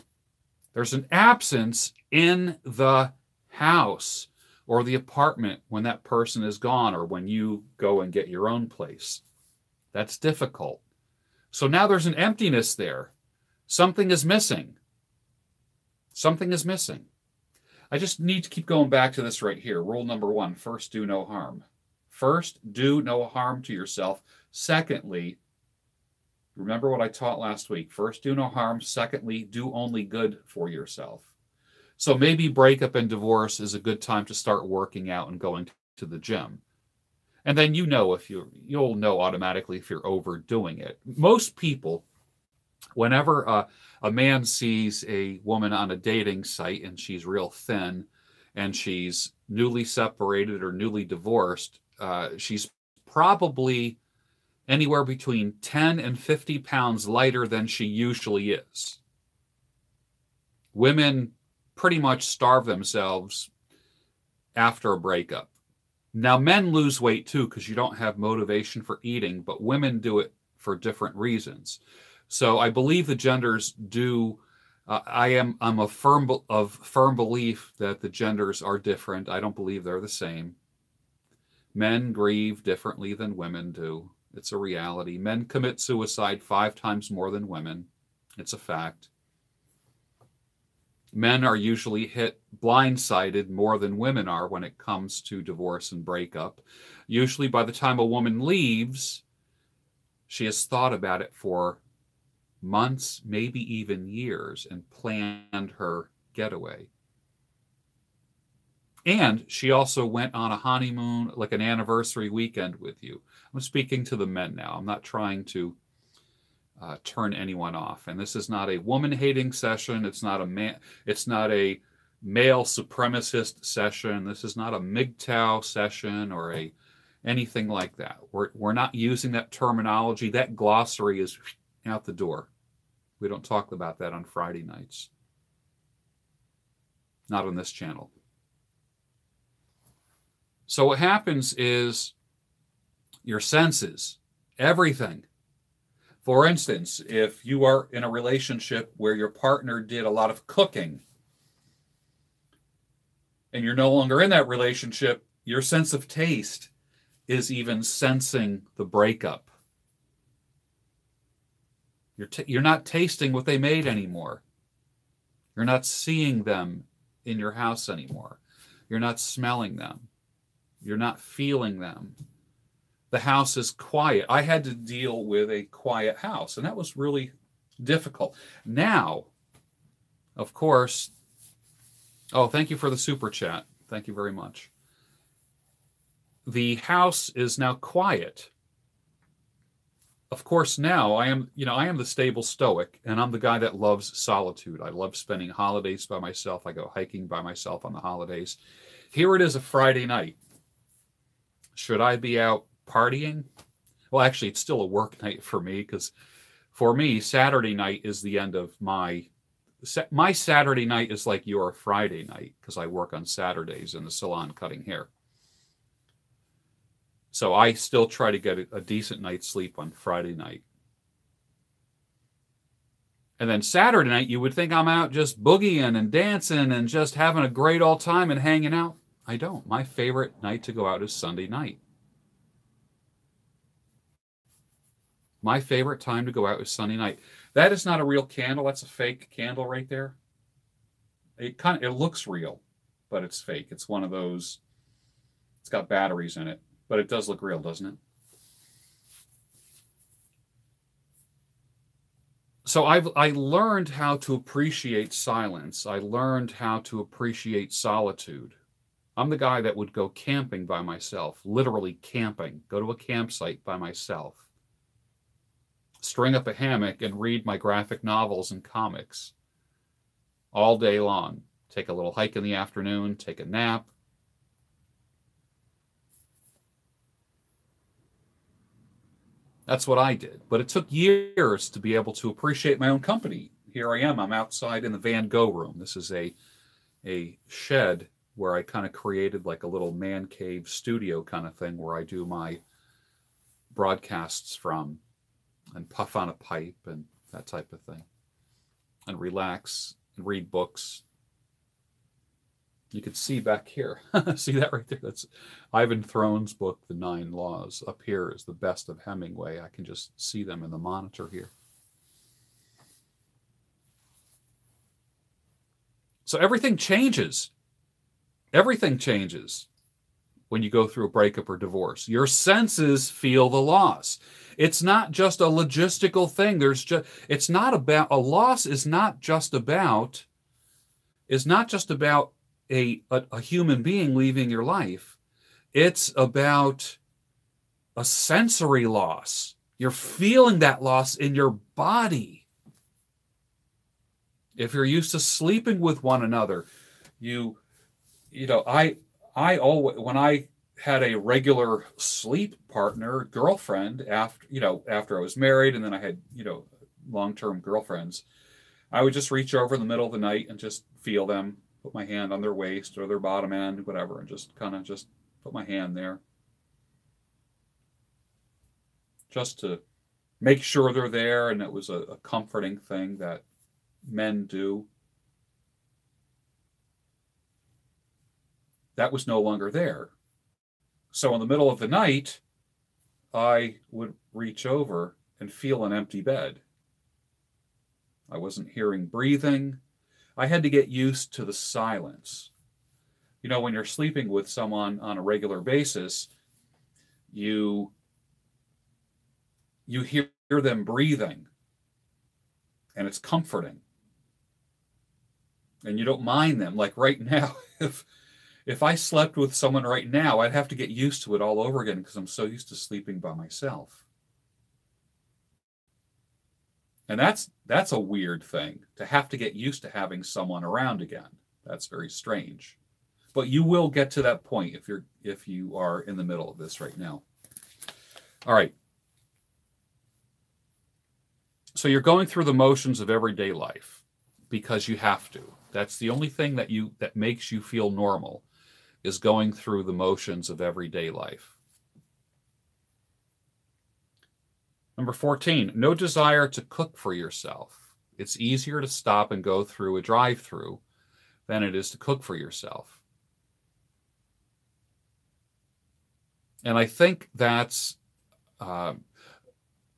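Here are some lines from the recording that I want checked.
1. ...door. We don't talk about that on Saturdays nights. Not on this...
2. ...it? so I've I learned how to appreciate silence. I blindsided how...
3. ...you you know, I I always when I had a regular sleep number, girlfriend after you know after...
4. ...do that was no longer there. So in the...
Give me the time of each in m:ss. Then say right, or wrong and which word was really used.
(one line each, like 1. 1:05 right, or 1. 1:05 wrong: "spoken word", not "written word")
1. 2:12 wrong: "Friday", not "Saturdays"
2. 4:07 wrong: "learned", not "blindsided"
3. 5:47 wrong: "partner", not "number"
4. 6:14 right.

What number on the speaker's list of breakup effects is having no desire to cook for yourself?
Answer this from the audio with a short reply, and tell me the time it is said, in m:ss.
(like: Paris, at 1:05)
14, at 7:24.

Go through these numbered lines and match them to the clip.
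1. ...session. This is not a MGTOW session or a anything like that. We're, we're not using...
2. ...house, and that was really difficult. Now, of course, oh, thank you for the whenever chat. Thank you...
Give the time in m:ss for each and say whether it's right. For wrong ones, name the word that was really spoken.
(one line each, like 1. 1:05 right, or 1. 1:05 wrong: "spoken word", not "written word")
1. 2:03 right
2. 2:56 wrong: "super", not "whenever".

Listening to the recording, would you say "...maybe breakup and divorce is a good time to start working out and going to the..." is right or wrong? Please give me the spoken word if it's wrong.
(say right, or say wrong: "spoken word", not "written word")
right.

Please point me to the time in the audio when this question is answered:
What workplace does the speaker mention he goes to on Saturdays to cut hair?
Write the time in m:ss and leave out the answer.
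3:33.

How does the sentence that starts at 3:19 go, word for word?
Here it is a Friday night should I be out partying?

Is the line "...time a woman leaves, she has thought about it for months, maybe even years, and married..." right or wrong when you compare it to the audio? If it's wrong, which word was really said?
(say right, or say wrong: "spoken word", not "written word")
wrong: "planned", not "married".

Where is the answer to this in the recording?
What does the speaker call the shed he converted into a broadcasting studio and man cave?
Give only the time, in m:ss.
4:44.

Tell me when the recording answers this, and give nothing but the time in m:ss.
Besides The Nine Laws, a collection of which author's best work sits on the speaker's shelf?
5:09.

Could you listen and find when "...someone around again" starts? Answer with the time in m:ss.
7:00.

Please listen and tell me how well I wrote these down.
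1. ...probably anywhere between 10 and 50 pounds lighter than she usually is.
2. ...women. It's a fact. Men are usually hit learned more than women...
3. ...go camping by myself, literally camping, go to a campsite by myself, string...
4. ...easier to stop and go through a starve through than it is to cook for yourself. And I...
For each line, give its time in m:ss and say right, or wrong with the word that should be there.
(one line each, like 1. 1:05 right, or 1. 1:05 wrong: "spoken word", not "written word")
1. 0:53 right
2. 1:27 wrong: "blindsided", not "learned"
3. 4:19 right
4. 7:28 wrong: "drive", not "starve".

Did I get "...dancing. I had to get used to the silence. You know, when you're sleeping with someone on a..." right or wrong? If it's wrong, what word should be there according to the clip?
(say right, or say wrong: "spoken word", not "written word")
wrong: "breathing", not "dancing".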